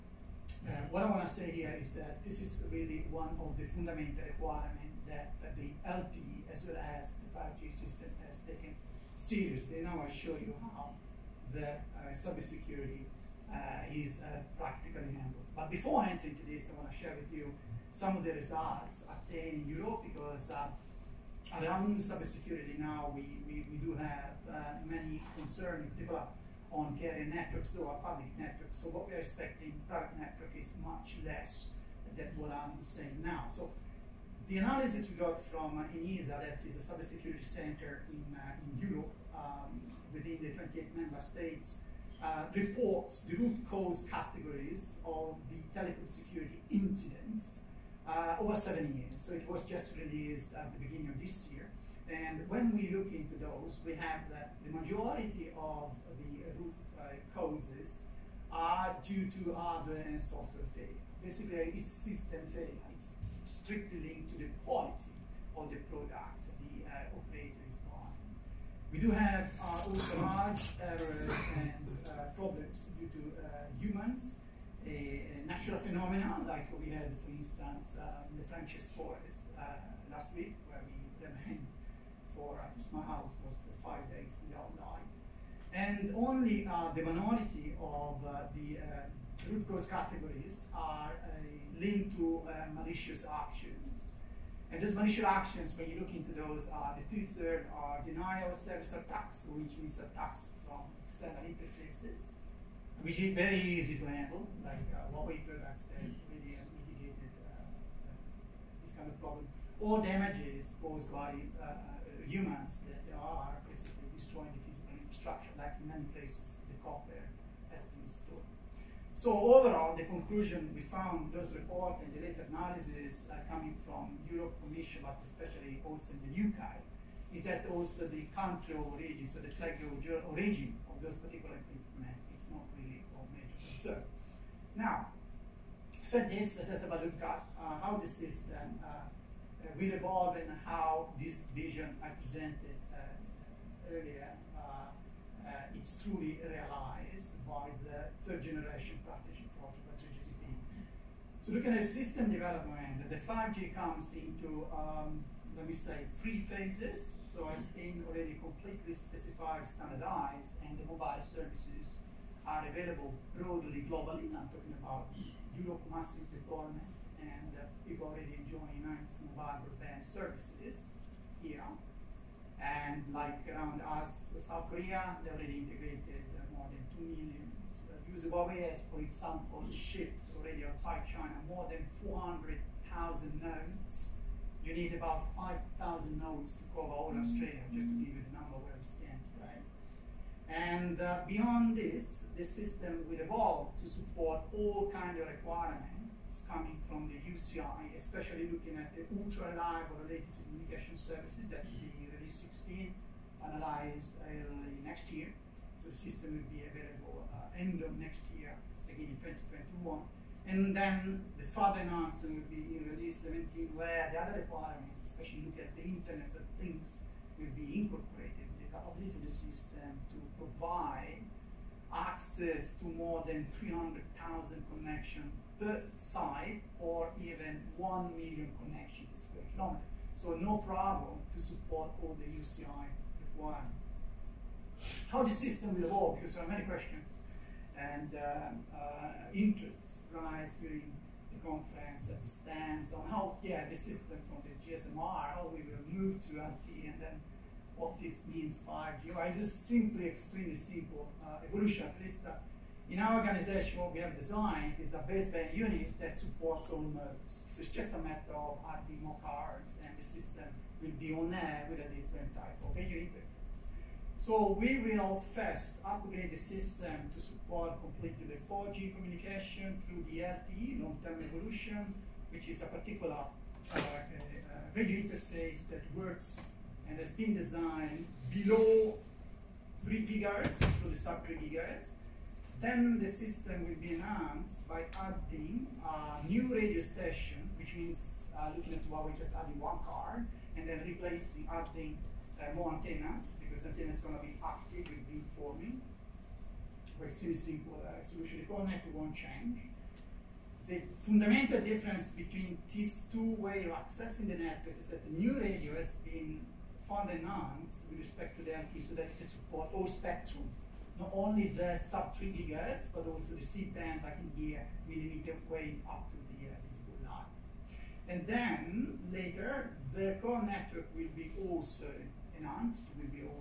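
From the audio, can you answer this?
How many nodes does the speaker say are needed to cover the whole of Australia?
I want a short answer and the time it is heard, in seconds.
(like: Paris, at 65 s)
5,000, at 185 s.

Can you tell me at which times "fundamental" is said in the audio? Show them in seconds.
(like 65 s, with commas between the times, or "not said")
3 s, 300 s.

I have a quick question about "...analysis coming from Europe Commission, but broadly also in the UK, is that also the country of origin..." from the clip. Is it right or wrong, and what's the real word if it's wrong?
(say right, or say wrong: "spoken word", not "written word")
wrong: "especially", not "broadly".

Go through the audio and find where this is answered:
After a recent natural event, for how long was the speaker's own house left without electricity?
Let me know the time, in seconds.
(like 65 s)
83 s.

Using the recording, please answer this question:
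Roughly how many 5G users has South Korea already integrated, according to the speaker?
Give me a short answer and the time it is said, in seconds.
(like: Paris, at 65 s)
more than 2 million, at 176 s.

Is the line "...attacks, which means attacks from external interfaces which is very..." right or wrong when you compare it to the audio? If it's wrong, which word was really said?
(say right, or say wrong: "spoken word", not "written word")
right.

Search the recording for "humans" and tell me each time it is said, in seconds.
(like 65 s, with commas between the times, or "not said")
73 s, 112 s.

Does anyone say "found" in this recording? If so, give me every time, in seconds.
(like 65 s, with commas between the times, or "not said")
120 s, 306 s.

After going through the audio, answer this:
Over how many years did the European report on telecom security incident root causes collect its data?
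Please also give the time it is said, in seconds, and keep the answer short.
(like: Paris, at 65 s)
7 years, at 48 s.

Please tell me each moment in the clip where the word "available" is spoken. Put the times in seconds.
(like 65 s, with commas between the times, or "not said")
162 s, 206 s.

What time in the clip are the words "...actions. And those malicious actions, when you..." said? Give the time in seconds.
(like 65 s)
93 s.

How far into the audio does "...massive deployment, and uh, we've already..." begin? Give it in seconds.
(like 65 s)
165 s.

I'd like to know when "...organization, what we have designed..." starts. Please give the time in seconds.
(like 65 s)
253 s.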